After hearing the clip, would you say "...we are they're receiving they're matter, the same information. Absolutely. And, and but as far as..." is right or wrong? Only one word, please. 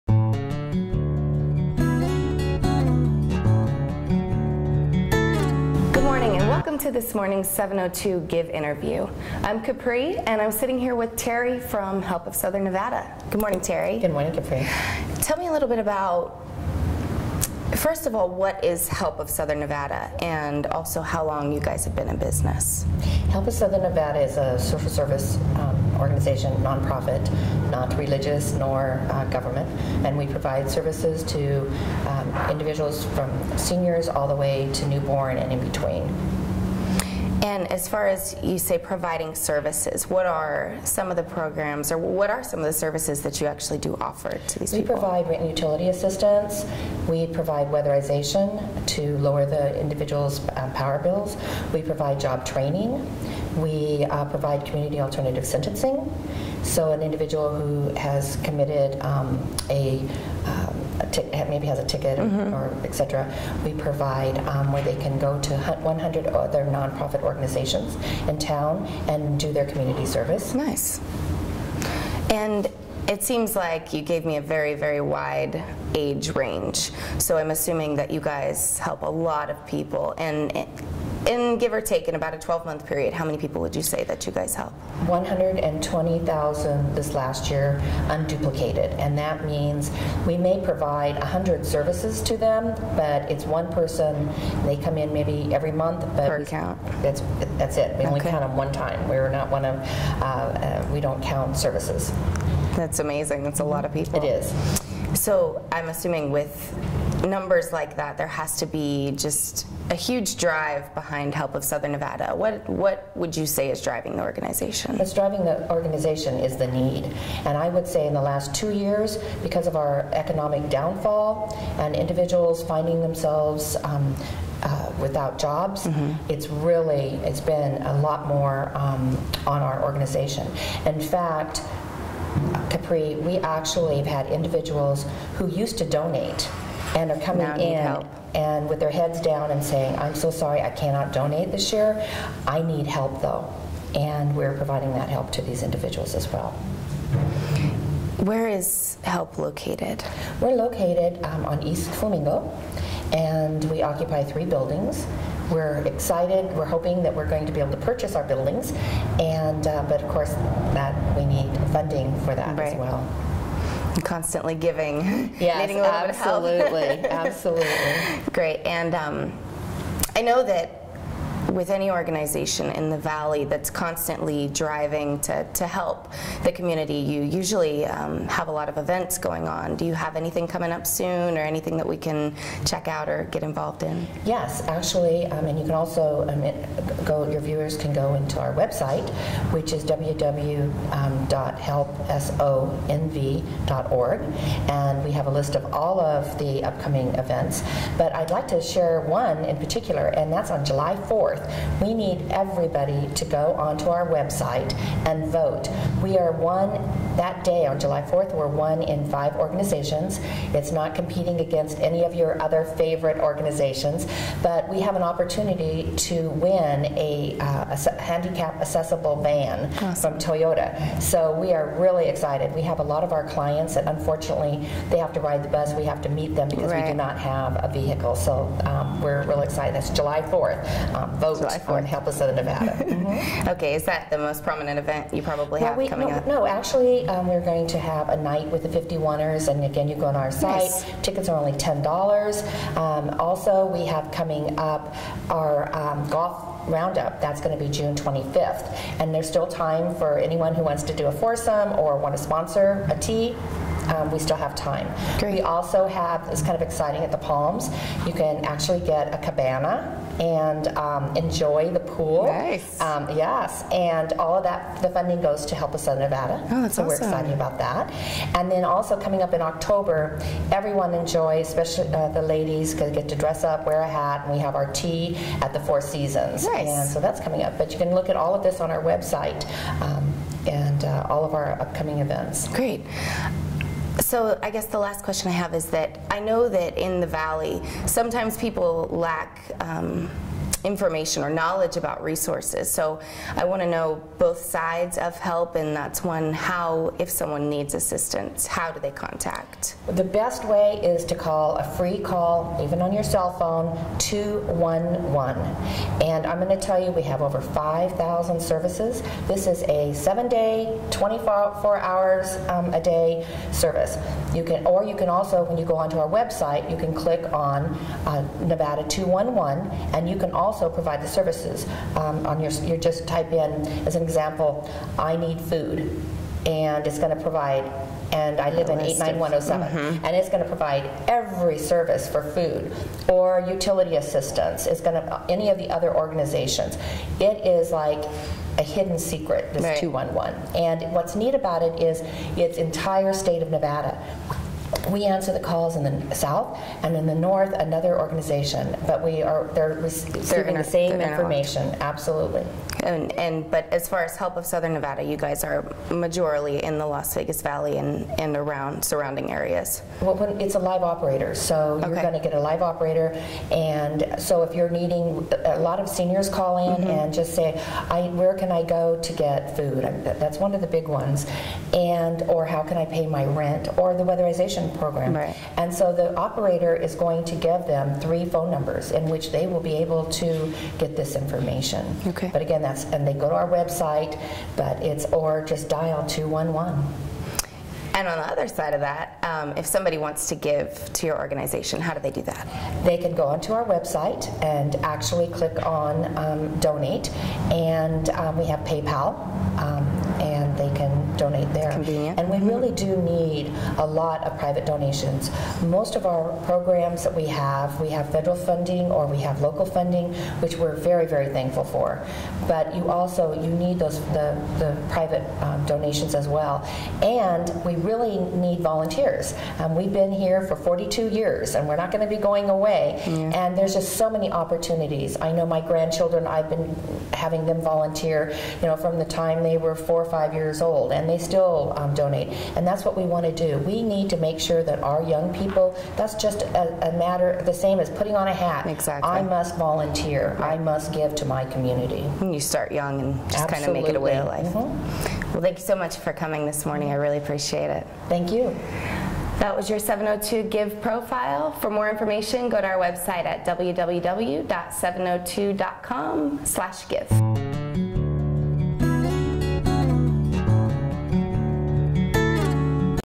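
wrong.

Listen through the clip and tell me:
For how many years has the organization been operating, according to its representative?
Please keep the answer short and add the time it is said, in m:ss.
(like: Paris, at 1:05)
42 years, at 7:00.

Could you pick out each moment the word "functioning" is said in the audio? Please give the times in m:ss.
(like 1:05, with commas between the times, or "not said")
not said.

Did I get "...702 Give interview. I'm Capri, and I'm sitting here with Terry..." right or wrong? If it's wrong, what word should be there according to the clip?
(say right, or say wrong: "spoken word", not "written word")
right.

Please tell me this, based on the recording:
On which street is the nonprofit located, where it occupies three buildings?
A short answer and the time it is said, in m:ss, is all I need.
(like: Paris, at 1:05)
East Flamingo, at 2:31.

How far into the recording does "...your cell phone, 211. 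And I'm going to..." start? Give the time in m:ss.
5:02.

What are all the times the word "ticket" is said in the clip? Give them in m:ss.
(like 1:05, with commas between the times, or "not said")
1:01, 4:01.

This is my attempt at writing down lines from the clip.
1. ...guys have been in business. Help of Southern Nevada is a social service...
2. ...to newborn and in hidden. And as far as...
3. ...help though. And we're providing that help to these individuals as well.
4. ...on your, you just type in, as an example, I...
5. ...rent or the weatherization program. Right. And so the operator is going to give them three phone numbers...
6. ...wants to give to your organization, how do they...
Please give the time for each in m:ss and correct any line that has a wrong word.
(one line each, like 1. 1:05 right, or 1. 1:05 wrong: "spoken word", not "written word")
1. 0:21 right
2. 0:34 wrong: "between", not "hidden"
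3. 2:22 right
4. 5:22 right
5. 6:13 right
6. 6:29 right.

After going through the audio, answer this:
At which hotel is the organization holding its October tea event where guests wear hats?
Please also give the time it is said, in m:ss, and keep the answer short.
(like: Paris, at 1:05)
Four Seasons, at 4:35.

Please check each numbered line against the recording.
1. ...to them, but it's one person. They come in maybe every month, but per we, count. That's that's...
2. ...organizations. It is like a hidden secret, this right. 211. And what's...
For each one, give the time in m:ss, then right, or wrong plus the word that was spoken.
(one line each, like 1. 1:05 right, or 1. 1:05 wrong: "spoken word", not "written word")
1. 1:32 right
2. 5:36 right.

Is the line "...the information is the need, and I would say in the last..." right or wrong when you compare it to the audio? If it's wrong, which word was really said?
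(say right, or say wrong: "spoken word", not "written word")
wrong: "organization", not "information".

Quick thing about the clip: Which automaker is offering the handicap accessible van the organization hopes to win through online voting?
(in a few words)
Toyota.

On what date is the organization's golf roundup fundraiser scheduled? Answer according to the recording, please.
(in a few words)
June 25th.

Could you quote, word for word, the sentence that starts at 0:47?
We provide weatherization to lower the individual's um, power bills.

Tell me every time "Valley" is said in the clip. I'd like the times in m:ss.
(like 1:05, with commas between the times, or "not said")
2:52, 4:47, 5:57.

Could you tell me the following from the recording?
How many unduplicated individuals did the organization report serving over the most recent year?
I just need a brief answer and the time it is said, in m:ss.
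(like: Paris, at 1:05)
120,000, at 1:25.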